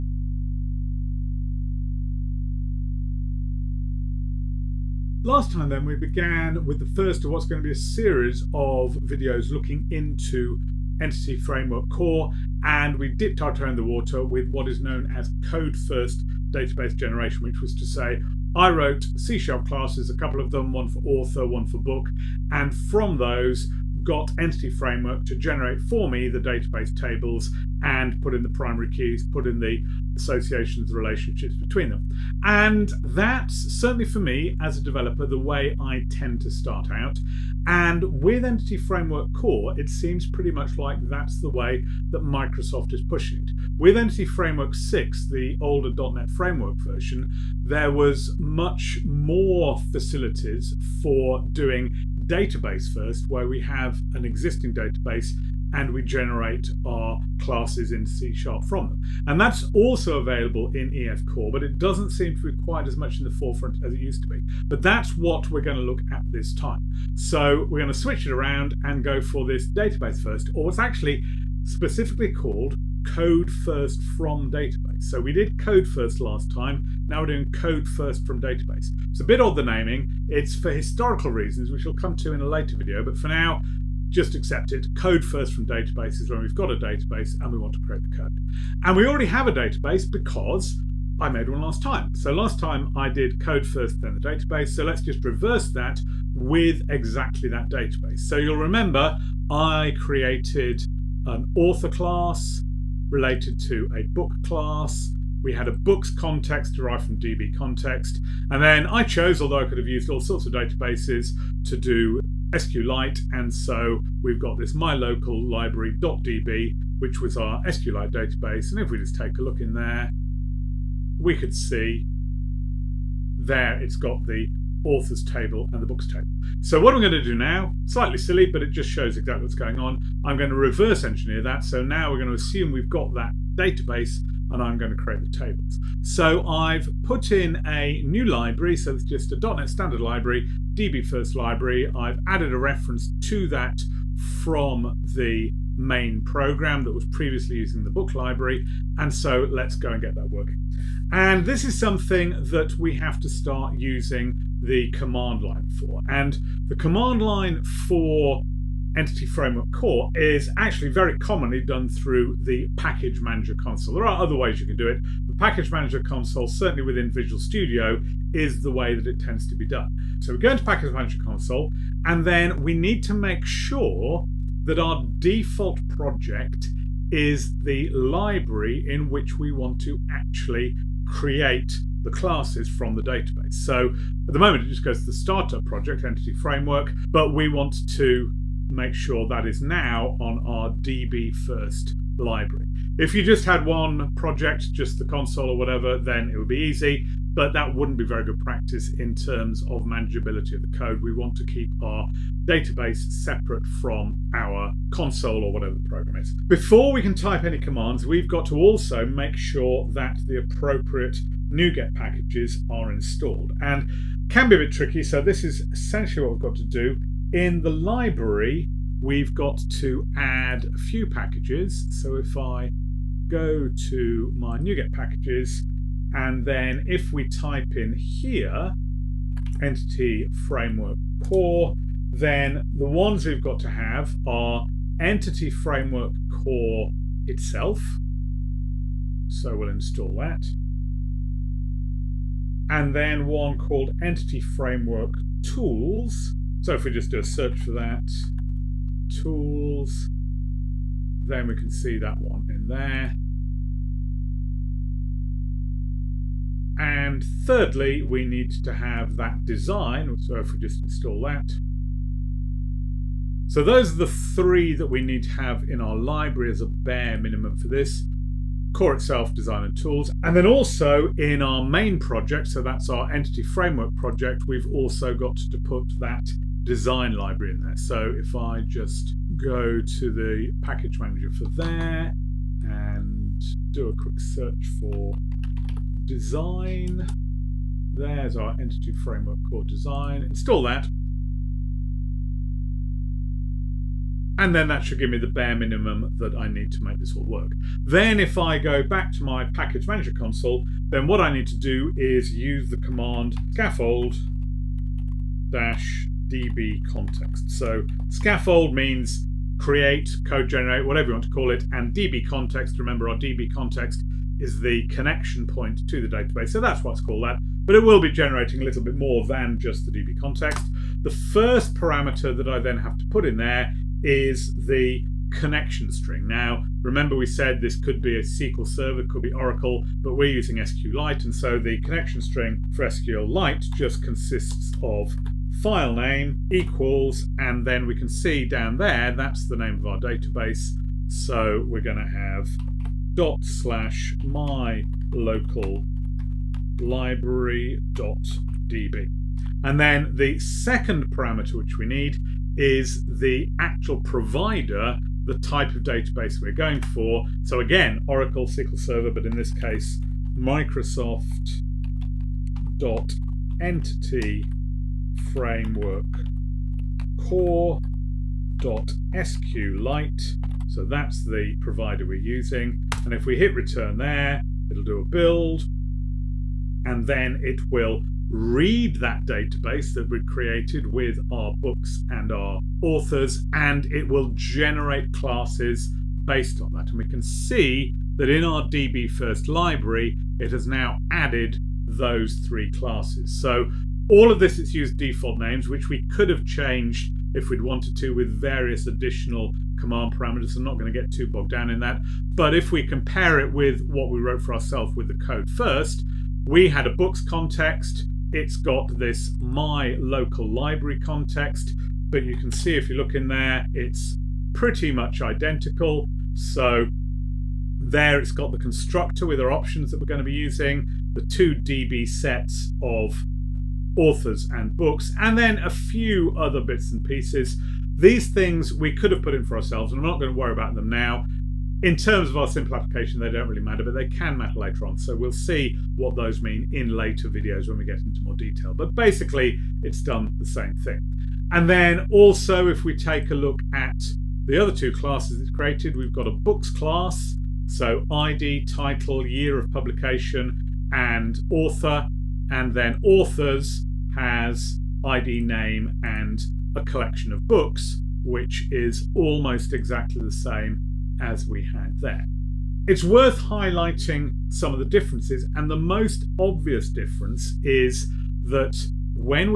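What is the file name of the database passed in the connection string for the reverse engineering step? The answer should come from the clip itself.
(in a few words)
mylocallibrary.db.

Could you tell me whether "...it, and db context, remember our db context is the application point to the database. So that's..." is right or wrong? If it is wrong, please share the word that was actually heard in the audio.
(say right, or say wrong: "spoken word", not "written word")
wrong: "connection", not "application".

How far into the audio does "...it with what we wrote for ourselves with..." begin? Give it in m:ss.
6:43.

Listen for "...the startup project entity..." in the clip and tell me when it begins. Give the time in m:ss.
3:05.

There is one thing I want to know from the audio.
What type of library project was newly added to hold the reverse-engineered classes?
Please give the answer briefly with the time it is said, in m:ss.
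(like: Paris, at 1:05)
.NET standard library, at 2:19.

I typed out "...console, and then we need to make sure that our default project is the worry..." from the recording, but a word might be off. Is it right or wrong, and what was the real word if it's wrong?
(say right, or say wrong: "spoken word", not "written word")
wrong: "library", not "worry".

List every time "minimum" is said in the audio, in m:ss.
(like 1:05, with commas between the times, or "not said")
4:27, 4:55.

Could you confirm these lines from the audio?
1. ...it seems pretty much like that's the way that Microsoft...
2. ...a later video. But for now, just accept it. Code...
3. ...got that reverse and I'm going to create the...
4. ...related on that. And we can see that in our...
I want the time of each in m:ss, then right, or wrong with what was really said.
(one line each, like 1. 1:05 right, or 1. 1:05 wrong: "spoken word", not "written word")
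1. 0:39 right
2. 1:22 right
3. 2:12 wrong: "database", not "reverse"
4. 6:26 wrong: "based", not "related".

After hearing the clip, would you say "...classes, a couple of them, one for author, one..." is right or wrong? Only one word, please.
right.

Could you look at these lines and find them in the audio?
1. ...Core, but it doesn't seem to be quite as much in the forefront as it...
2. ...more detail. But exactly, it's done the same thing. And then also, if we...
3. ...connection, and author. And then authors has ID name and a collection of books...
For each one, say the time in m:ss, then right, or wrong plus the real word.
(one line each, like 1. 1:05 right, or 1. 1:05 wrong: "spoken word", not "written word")
1. 1:01 right
2. 7:18 wrong: "basically", not "exactly"
3. 7:29 wrong: "publication", not "connection".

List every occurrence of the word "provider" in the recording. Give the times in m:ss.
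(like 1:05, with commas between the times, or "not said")
5:54, 6:11.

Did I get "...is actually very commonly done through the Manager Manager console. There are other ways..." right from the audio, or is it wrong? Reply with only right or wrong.
wrong.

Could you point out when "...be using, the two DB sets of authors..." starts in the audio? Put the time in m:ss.
7:00.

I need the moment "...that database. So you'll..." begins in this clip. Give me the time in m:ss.
1:37.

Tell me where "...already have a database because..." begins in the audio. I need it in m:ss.
1:29.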